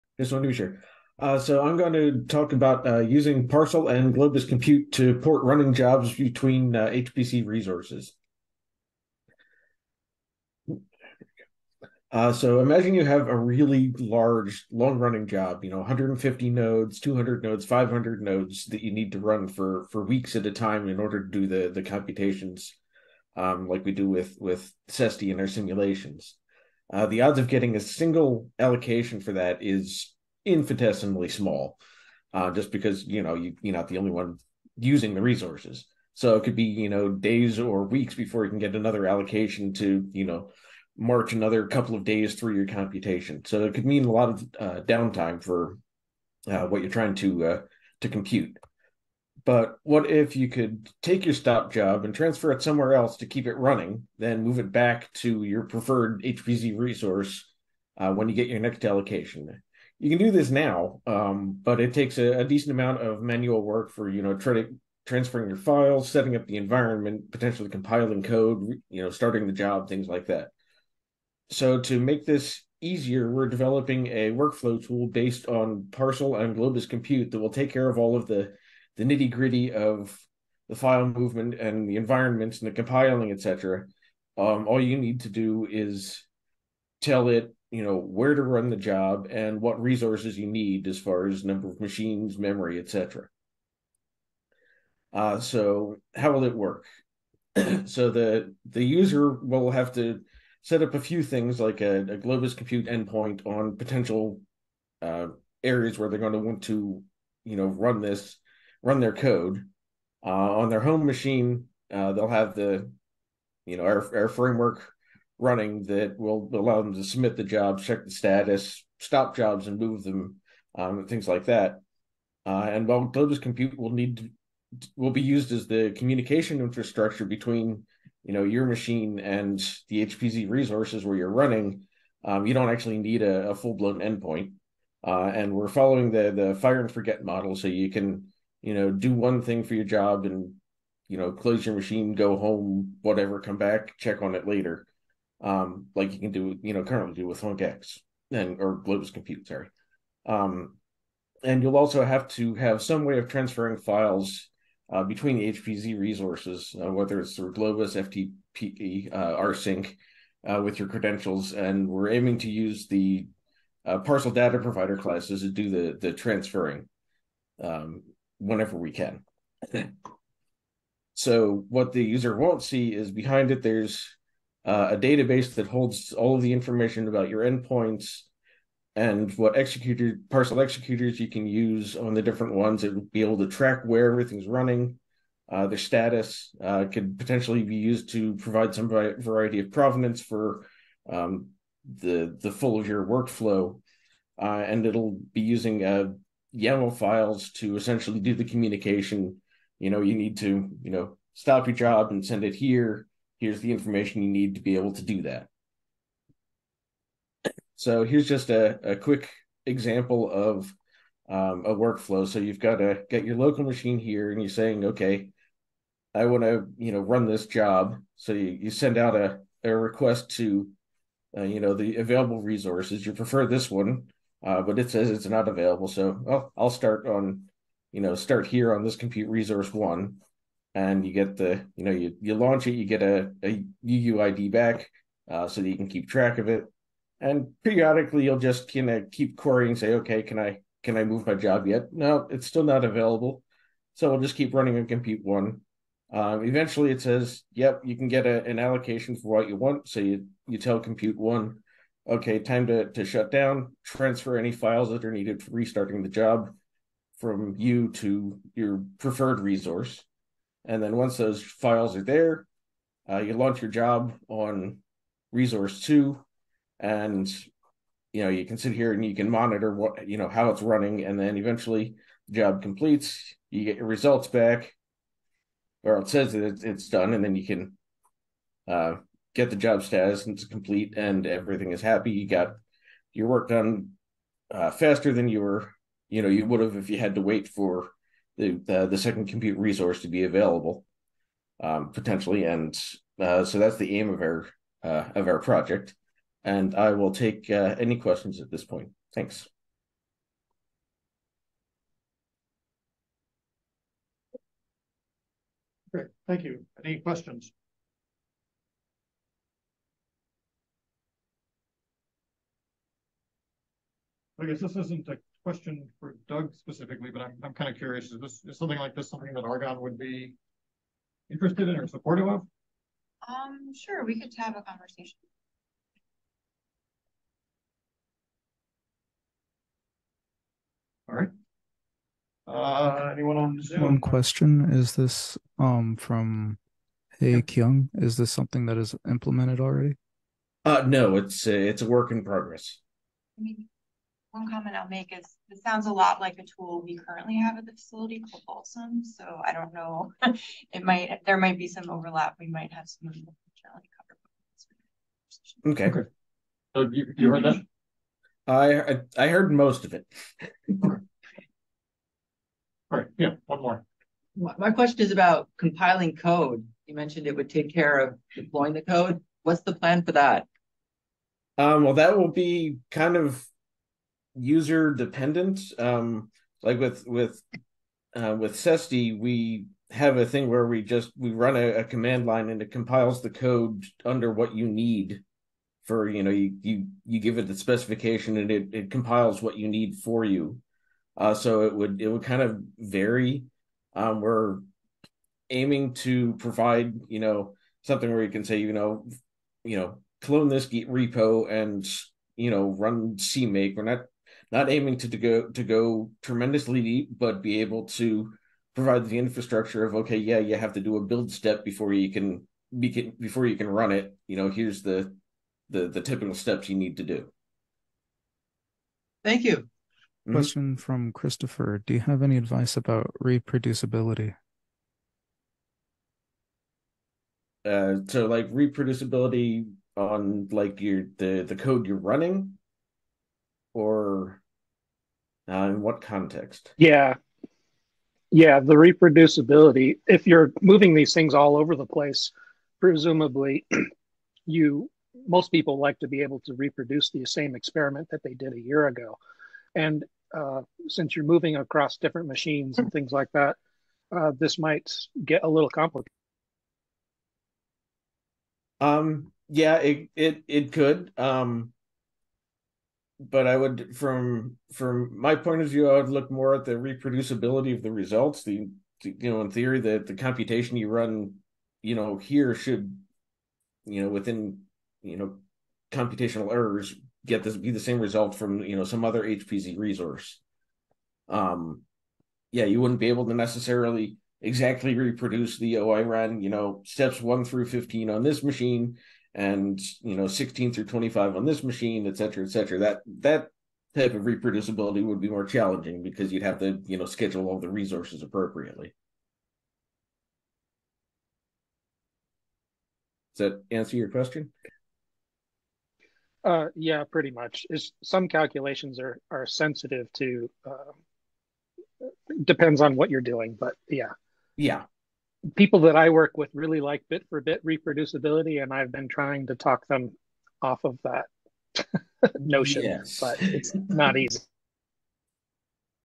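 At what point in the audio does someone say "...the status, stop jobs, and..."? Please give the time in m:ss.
1:58.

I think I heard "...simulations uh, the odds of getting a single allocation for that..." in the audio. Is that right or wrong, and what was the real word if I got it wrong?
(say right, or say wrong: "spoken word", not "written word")
right.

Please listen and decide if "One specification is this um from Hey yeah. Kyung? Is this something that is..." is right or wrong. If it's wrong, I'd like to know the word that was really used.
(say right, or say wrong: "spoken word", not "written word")
wrong: "question", not "specification".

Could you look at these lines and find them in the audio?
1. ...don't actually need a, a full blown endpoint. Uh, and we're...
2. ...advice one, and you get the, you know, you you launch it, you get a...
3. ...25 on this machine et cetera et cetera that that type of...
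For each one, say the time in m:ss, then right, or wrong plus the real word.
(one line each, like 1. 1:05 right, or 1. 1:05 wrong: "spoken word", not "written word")
1. 2:12 right
2. 3:49 wrong: "resource", not "advice"
3. 8:10 right.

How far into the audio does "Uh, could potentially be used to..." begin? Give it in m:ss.
3:06.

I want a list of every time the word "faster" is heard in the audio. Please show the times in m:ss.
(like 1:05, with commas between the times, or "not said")
4:44.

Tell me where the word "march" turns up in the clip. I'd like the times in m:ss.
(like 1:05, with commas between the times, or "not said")
0:40.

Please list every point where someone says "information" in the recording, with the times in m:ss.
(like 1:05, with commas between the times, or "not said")
2:56, 3:23.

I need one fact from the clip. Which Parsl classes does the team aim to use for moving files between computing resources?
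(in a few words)
data provider classes.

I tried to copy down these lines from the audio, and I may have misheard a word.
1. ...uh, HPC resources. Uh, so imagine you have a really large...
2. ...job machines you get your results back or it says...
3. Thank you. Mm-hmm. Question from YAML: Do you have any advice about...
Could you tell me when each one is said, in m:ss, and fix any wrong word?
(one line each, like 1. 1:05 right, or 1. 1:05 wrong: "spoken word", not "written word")
1. 0:06 right
2. 4:32 wrong: "completes", not "machines"
3. 6:59 wrong: "Christopher", not "YAML".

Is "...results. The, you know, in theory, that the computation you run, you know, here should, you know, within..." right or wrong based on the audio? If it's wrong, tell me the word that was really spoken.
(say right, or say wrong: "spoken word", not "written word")
right.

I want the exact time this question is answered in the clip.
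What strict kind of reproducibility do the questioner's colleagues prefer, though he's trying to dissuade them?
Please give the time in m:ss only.
8:37.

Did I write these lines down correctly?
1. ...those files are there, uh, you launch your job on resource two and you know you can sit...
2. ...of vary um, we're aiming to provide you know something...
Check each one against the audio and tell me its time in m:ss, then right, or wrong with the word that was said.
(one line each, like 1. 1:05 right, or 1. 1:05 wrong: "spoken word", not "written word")
1. 4:21 right
2. 6:32 right.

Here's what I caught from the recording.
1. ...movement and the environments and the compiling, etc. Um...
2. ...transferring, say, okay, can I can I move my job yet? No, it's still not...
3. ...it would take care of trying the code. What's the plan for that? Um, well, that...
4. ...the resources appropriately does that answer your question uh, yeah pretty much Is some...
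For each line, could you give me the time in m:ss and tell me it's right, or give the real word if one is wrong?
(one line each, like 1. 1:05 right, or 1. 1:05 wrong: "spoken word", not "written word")
1. 1:21 right
2. 3:59 wrong: "querying", not "transferring"
3. 6:07 wrong: "deploying", not "trying"
4. 8:17 right.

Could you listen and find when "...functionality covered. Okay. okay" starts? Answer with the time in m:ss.
5:53.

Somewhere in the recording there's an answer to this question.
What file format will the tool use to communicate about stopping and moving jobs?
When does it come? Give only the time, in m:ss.
3:16.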